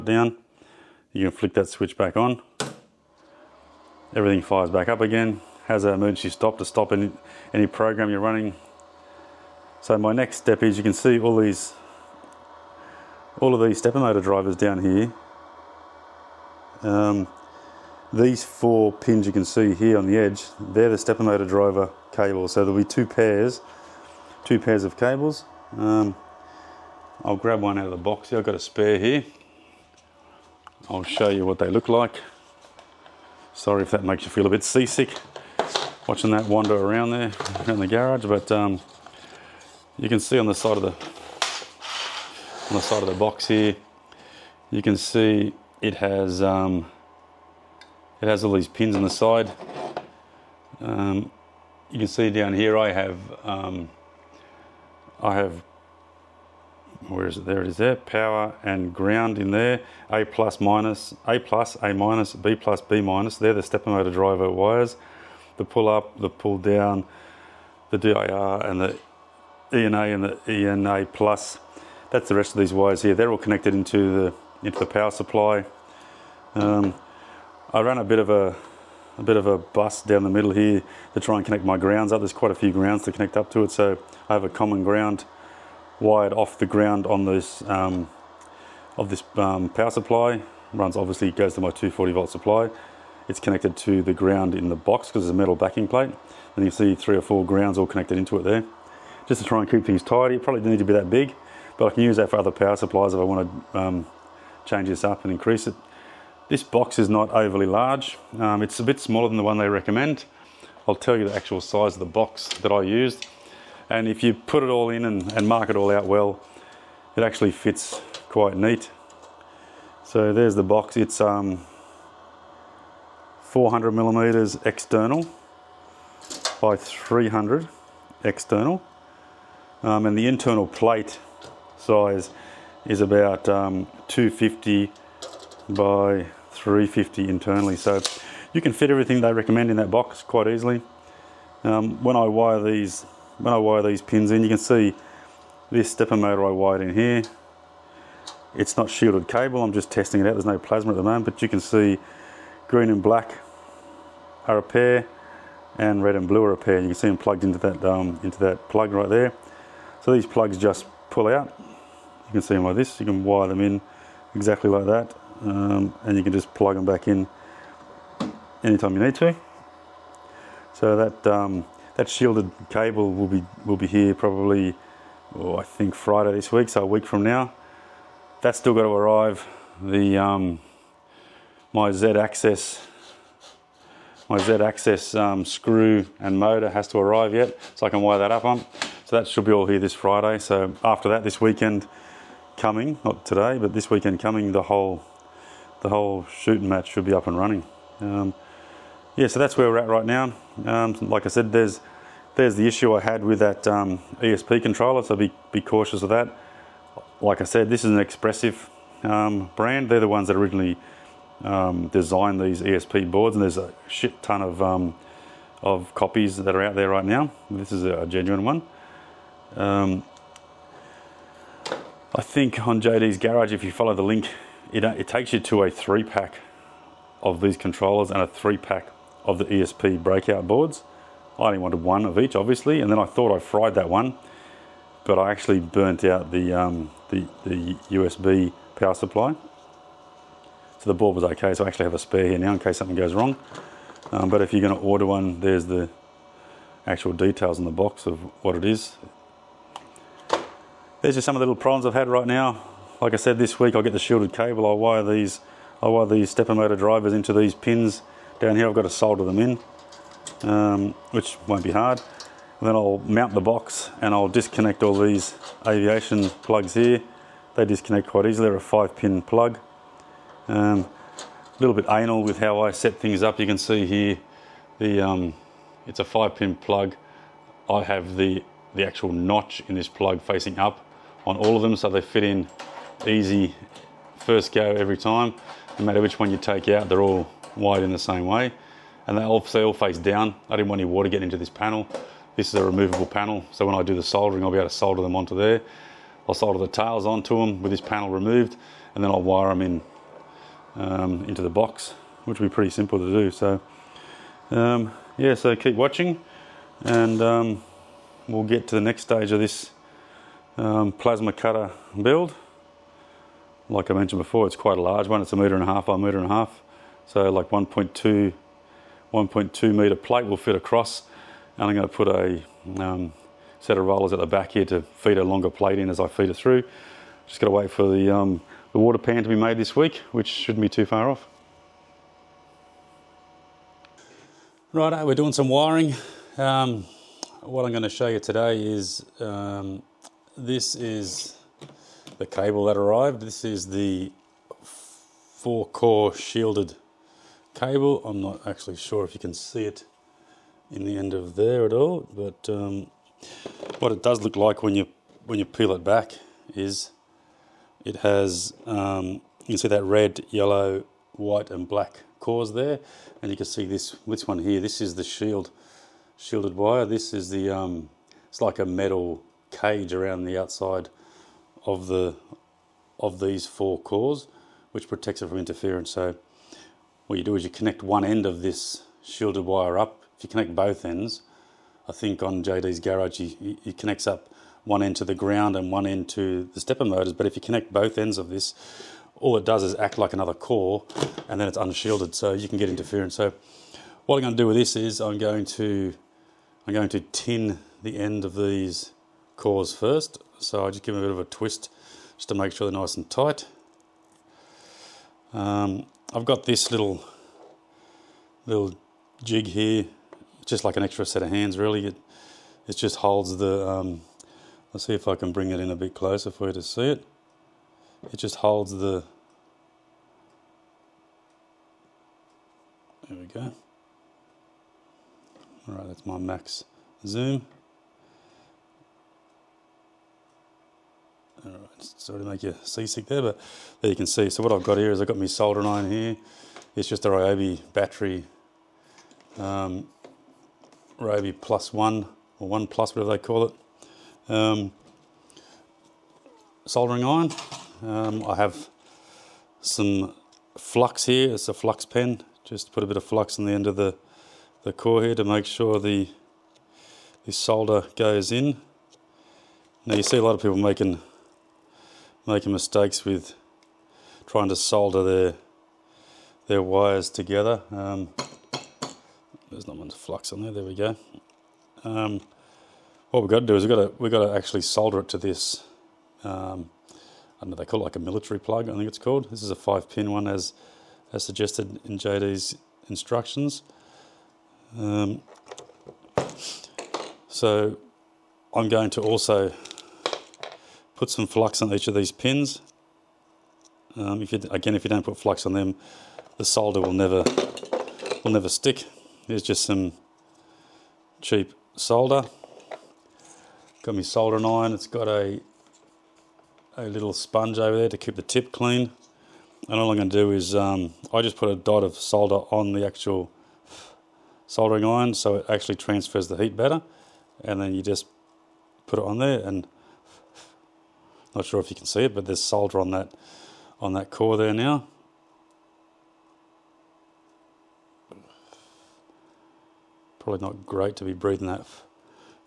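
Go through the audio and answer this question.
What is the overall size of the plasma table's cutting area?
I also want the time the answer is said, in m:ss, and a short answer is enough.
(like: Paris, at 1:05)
1.5 m by 1.5 m, at 5:15.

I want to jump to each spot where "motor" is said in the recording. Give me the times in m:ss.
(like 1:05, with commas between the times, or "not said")
0:13, 0:21, 1:03, 2:26, 3:06, 4:16, 6:26.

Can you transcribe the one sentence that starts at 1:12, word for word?
That's the rest of these wires here.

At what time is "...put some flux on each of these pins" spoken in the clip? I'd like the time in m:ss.
8:10.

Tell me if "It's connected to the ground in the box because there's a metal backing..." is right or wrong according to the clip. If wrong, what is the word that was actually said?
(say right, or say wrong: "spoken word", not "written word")
right.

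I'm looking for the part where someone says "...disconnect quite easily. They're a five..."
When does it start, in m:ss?
4:27.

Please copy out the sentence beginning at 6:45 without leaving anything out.
Um, I've got this little little jig here, just like an extra set of hands really.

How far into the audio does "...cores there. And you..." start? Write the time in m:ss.
6:02.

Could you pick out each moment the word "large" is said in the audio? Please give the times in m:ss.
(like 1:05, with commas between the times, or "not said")
1:47, 5:14.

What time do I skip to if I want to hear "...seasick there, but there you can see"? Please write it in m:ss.
7:12.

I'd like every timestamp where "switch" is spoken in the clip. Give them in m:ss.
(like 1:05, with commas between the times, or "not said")
0:01.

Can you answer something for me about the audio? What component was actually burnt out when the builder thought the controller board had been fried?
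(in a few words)
USB power supply.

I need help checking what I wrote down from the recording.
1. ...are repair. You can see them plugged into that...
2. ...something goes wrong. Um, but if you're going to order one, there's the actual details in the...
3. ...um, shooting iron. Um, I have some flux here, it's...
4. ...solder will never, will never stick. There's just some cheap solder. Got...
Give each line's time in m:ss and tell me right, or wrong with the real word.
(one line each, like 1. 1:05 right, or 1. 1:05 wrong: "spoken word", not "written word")
1. 2:36 right
2. 4:02 right
3. 7:24 wrong: "soldering", not "shooting"
4. 8:16 right.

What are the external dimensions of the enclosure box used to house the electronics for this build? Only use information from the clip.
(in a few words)
400 mm by 300 mm.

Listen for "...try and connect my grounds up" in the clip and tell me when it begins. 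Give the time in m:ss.
1:21.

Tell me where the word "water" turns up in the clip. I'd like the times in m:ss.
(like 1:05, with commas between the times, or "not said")
4:50, 5:28.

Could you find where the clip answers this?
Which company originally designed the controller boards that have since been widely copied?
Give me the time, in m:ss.
3:27.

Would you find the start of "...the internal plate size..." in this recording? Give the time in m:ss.
2:10.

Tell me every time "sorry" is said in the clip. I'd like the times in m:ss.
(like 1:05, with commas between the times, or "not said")
0:33, 7:11.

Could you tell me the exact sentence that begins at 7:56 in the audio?
Um, I don't know, they call it like a military plug, I think it's called.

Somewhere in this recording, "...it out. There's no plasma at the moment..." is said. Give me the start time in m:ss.
2:30.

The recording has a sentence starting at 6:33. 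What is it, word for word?
So what I'm going to do with this is I'm going to I'm going to tin the end of these cores first.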